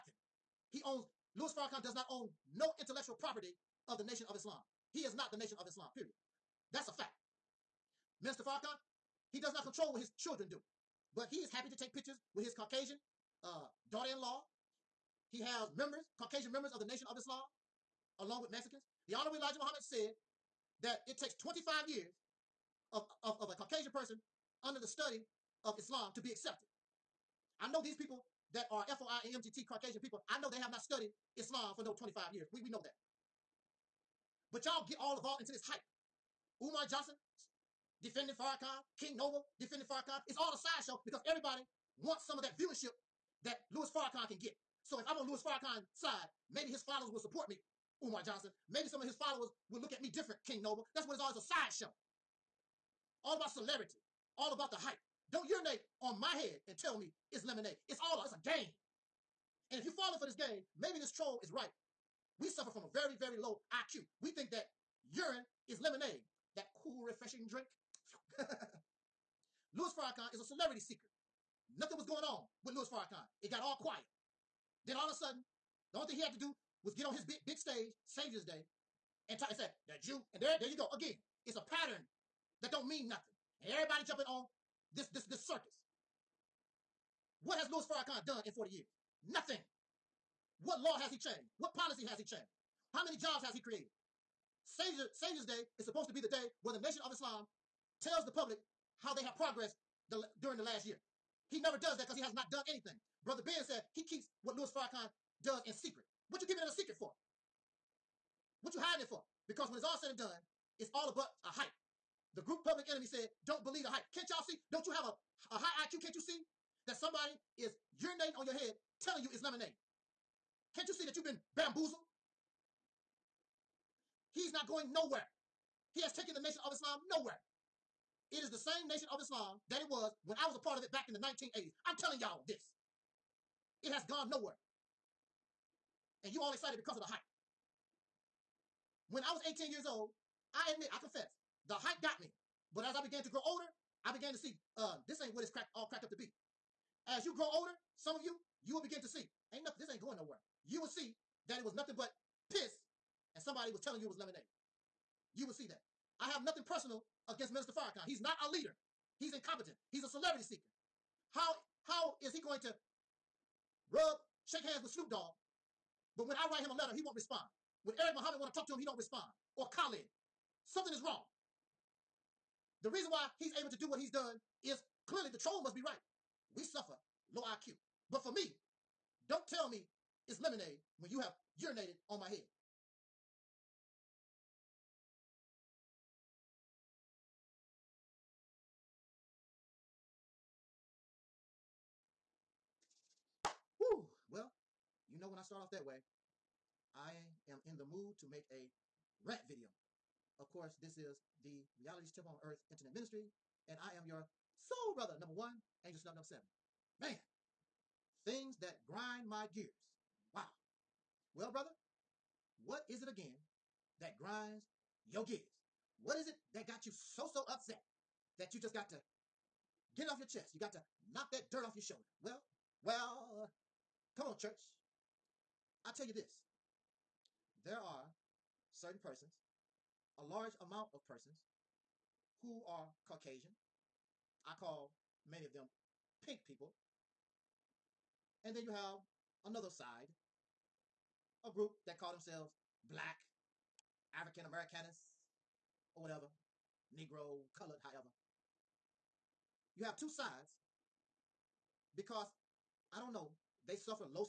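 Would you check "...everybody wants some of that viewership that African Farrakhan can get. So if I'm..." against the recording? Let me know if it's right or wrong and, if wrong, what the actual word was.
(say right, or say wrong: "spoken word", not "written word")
wrong: "Louis", not "African".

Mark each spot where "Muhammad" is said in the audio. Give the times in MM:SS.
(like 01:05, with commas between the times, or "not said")
00:19, 02:48.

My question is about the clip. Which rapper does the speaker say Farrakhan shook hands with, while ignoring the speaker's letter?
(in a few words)
Snoop Dogg.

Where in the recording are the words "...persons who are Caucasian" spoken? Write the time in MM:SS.
03:51.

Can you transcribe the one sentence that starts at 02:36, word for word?
I have nothing personal against Minister Farrakhan.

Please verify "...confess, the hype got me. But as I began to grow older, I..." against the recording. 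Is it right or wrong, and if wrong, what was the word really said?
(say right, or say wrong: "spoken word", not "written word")
right.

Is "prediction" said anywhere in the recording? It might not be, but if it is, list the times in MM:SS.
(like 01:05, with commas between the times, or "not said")
not said.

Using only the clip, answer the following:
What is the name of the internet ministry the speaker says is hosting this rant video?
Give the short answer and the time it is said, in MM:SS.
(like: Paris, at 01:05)
Reality's Temple on Earth, at 03:21.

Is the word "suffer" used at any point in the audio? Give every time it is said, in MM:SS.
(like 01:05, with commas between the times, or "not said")
01:02, 02:56, 04:13.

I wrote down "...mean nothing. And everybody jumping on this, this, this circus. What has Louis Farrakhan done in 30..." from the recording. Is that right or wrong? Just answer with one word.
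wrong.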